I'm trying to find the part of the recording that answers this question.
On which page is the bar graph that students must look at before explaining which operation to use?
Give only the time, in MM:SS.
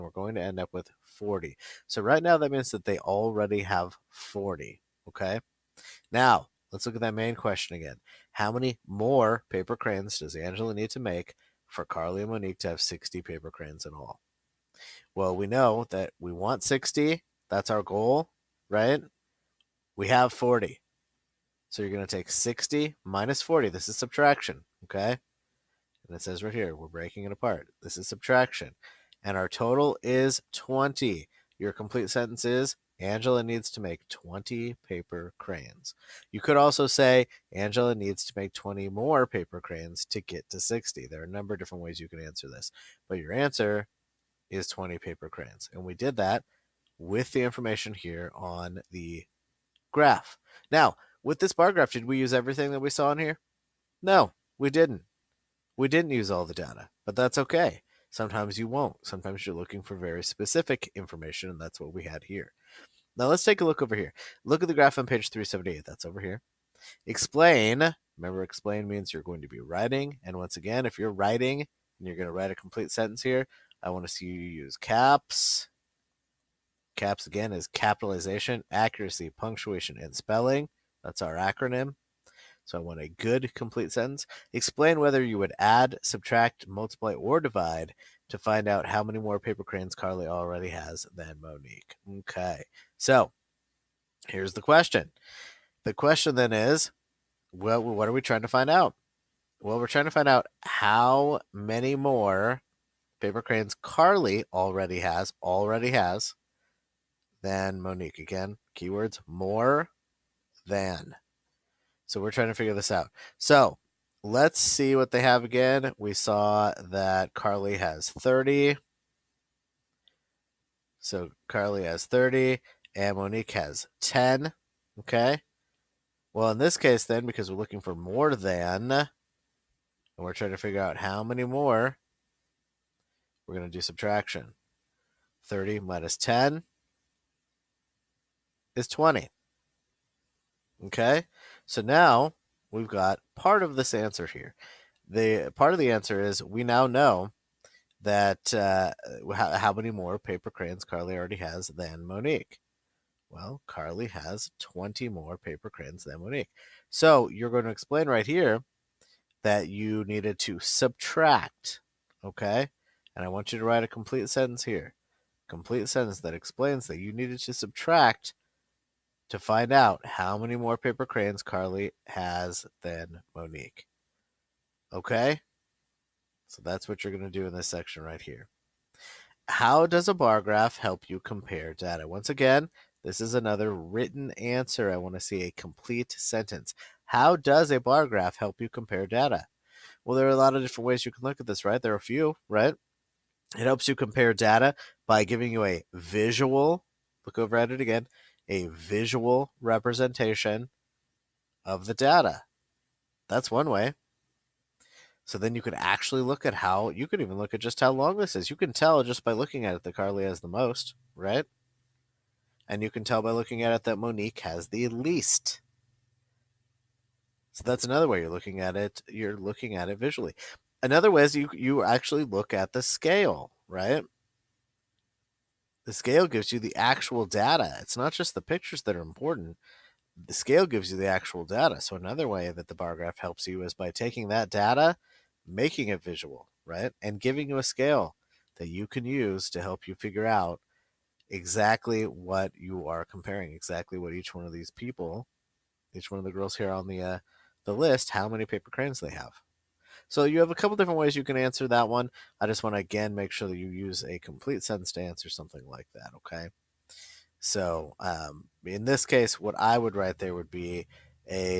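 01:05.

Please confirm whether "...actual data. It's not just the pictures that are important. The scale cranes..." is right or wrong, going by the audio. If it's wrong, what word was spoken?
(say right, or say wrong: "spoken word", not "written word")
wrong: "gives", not "cranes".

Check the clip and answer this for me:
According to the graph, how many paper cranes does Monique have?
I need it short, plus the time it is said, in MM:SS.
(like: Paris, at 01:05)
10, at 02:03.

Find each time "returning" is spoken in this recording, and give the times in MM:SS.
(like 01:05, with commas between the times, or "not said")
not said.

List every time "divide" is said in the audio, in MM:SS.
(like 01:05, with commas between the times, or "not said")
01:27.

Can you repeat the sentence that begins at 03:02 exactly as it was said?
Once again, this is another written answer.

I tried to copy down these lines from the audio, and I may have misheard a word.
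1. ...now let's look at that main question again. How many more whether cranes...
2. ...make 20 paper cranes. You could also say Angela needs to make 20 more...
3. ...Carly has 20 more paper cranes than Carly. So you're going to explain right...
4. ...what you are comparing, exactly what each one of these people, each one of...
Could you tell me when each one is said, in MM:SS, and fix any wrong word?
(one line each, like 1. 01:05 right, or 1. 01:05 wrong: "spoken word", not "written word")
1. 00:06 wrong: "paper", not "whether"
2. 00:33 right
3. 02:33 wrong: "Monique", not "Carly"
4. 04:02 right.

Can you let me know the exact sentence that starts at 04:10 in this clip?
So you have a couple different ways you can answer that one.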